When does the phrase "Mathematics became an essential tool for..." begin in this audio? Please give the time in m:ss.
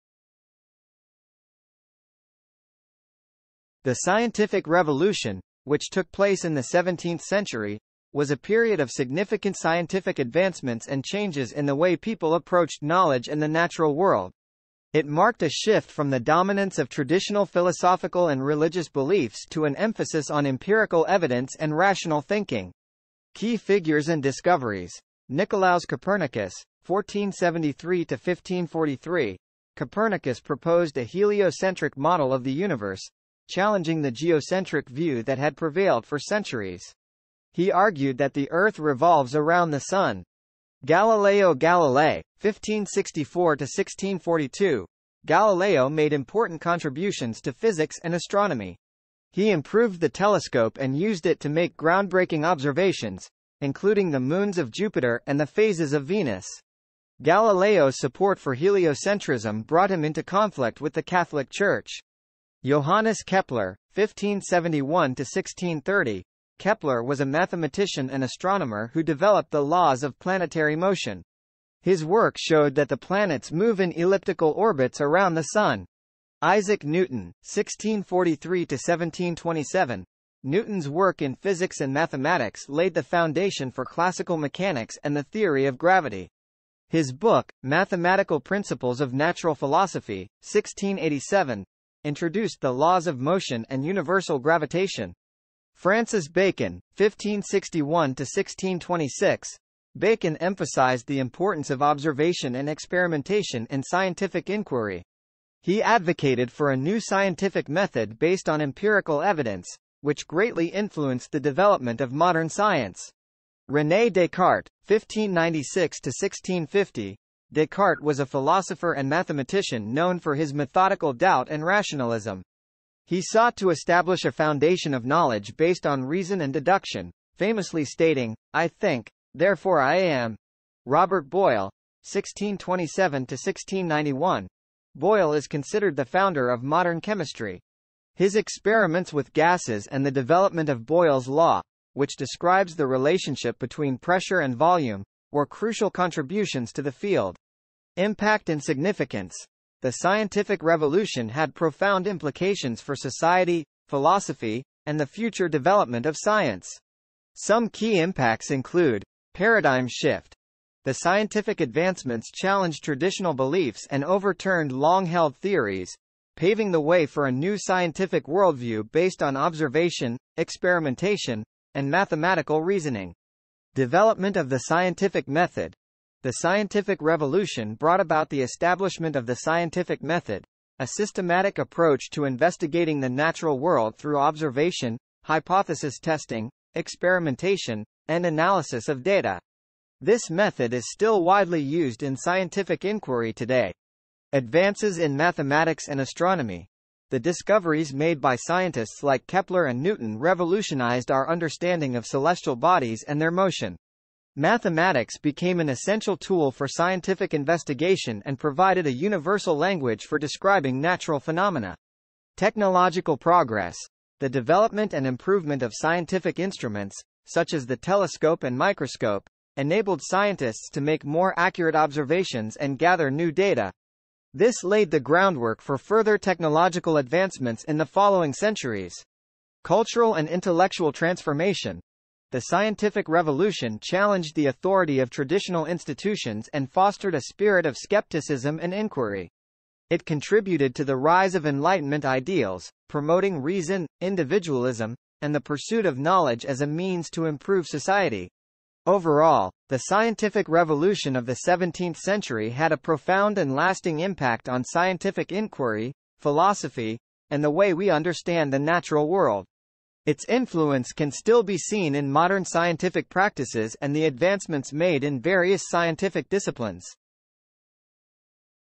3:24.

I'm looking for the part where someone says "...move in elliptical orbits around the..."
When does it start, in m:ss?
1:13.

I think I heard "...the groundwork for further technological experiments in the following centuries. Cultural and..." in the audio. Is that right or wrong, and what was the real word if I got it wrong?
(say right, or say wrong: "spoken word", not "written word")
wrong: "advancements", not "experiments".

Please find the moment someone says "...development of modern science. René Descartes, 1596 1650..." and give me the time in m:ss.
1:51.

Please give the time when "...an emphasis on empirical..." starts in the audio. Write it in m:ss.
0:19.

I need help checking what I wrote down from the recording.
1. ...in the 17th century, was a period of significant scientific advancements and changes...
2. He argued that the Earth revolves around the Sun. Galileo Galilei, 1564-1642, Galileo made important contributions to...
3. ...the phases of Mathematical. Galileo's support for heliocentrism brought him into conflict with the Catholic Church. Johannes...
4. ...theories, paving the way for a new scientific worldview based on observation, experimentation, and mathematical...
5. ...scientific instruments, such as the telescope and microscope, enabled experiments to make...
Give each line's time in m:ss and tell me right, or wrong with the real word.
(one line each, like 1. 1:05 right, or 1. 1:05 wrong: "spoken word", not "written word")
1. 0:06 right
2. 0:37 right
3. 0:55 wrong: "Venus", not "Mathematical"
4. 2:45 right
5. 3:35 wrong: "scientists", not "experiments".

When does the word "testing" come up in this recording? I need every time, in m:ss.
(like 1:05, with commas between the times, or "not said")
3:05.